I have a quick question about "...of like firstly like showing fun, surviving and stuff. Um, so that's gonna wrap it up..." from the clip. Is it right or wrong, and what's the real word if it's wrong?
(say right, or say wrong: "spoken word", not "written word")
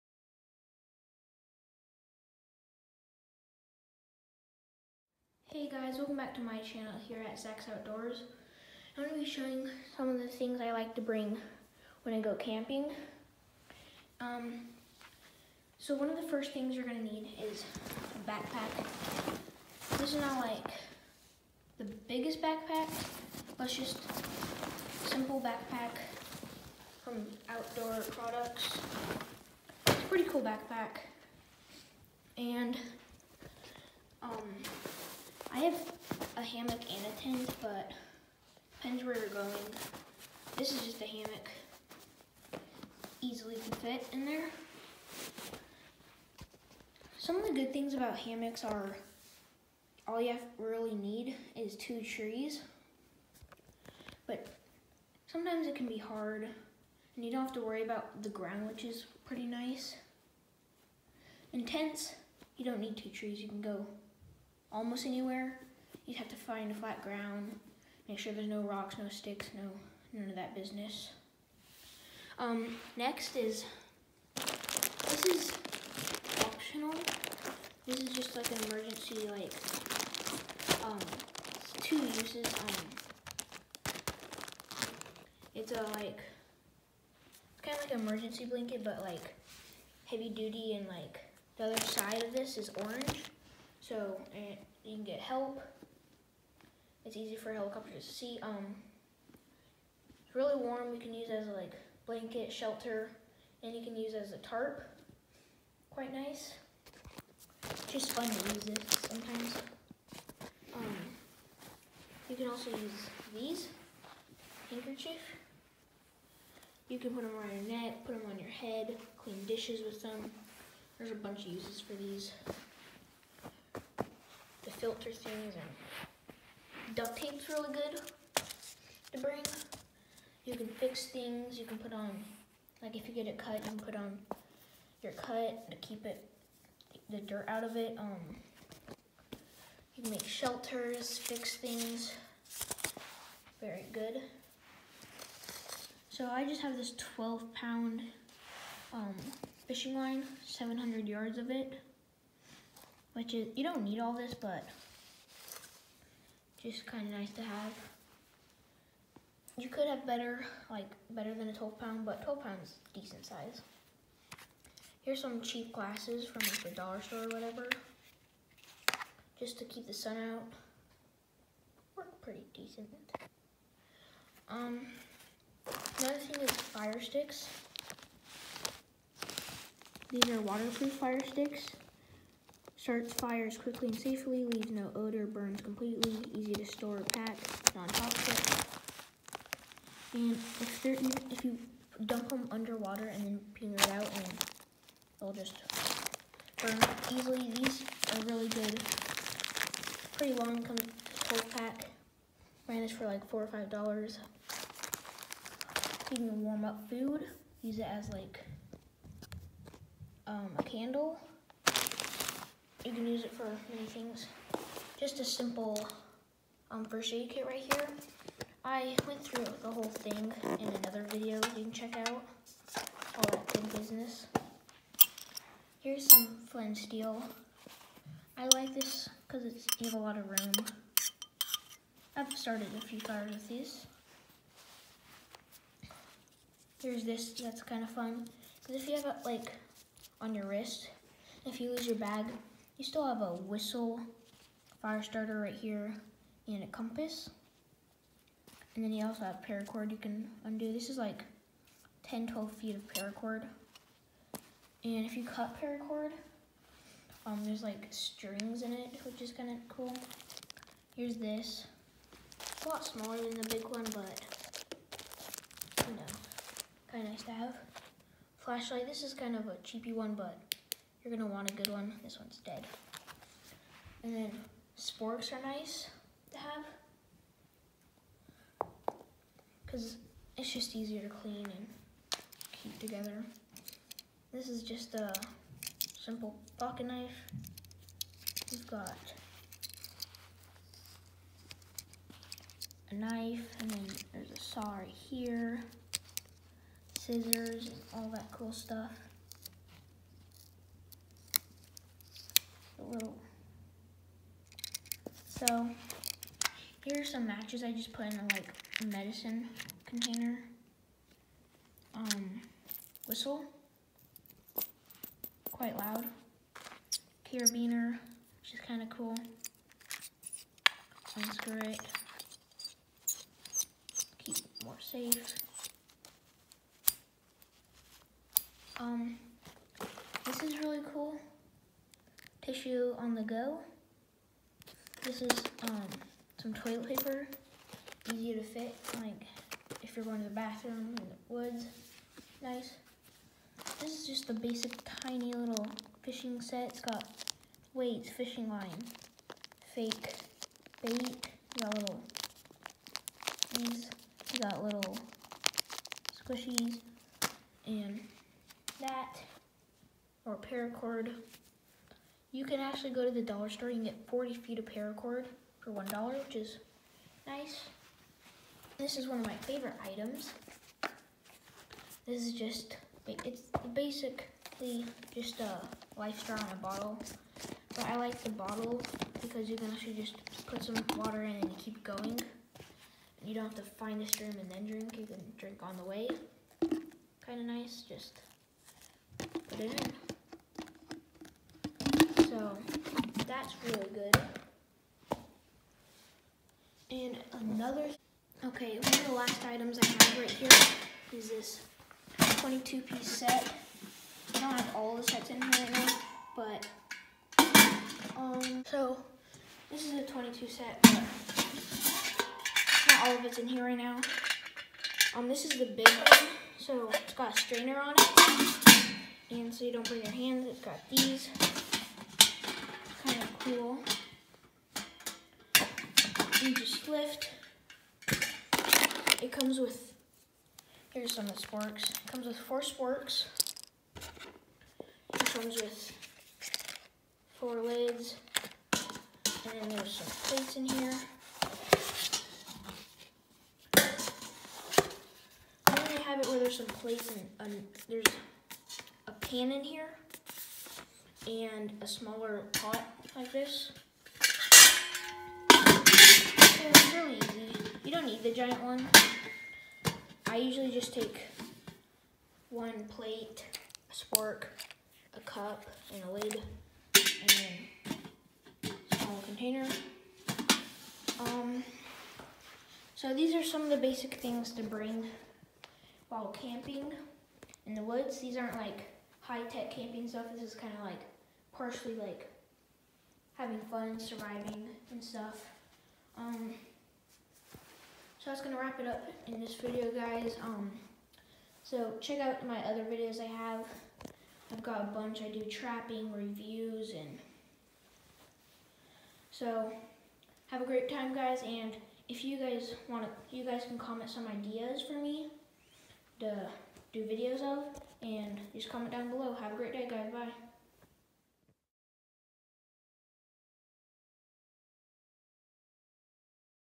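wrong: "having", not "showing".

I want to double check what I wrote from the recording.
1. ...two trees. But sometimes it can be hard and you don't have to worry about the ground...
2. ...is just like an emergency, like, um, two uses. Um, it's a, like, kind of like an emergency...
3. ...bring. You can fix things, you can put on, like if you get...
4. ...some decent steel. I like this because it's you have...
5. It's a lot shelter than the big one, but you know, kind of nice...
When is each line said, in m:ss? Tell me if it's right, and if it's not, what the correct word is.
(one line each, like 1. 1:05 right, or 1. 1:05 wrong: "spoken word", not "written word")
1. 0:51 right
2. 1:17 right
3. 2:09 right
4. 3:46 wrong: "flint", not "decent"
5. 4:22 wrong: "smaller", not "shelter".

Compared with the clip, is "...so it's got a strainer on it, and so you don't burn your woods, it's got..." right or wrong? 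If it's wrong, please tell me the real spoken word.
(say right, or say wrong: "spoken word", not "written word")
wrong: "hands", not "woods".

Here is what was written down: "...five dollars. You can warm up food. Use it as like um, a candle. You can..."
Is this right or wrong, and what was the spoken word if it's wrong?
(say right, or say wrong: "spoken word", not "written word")
right.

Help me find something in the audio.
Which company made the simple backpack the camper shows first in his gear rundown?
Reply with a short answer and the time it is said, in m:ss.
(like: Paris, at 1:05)
Outdoor Products, at 0:27.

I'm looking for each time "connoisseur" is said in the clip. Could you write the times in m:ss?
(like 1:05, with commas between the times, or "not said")
not said.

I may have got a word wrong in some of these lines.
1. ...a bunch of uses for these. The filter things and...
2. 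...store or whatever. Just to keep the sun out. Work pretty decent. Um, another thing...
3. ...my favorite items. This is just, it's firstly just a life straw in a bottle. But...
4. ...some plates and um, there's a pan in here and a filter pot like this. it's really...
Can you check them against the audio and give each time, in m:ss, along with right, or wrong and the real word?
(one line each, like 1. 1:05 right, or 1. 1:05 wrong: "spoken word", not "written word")
1. 2:01 right
2. 2:47 right
3. 6:09 wrong: "basically", not "firstly"
4. 7:26 wrong: "smaller", not "filter".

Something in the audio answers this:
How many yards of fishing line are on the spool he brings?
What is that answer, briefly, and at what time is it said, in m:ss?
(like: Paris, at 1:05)
700 yards, at 2:30.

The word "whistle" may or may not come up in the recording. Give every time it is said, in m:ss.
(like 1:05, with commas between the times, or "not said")
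4:03, 5:13.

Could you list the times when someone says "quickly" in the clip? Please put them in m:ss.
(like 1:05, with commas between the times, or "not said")
3:03.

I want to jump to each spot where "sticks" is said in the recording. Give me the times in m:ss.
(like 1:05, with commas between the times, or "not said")
1:09, 2:57, 3:01.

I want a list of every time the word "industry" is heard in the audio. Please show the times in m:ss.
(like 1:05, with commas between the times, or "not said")
not said.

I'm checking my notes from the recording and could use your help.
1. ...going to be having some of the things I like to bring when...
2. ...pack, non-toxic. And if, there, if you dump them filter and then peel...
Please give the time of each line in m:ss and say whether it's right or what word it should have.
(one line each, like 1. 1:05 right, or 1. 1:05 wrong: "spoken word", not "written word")
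1. 0:09 wrong: "showing", not "having"
2. 3:07 wrong: "underwater", not "filter".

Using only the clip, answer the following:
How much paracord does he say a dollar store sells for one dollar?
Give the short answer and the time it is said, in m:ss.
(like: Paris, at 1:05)
40 feet, at 6:04.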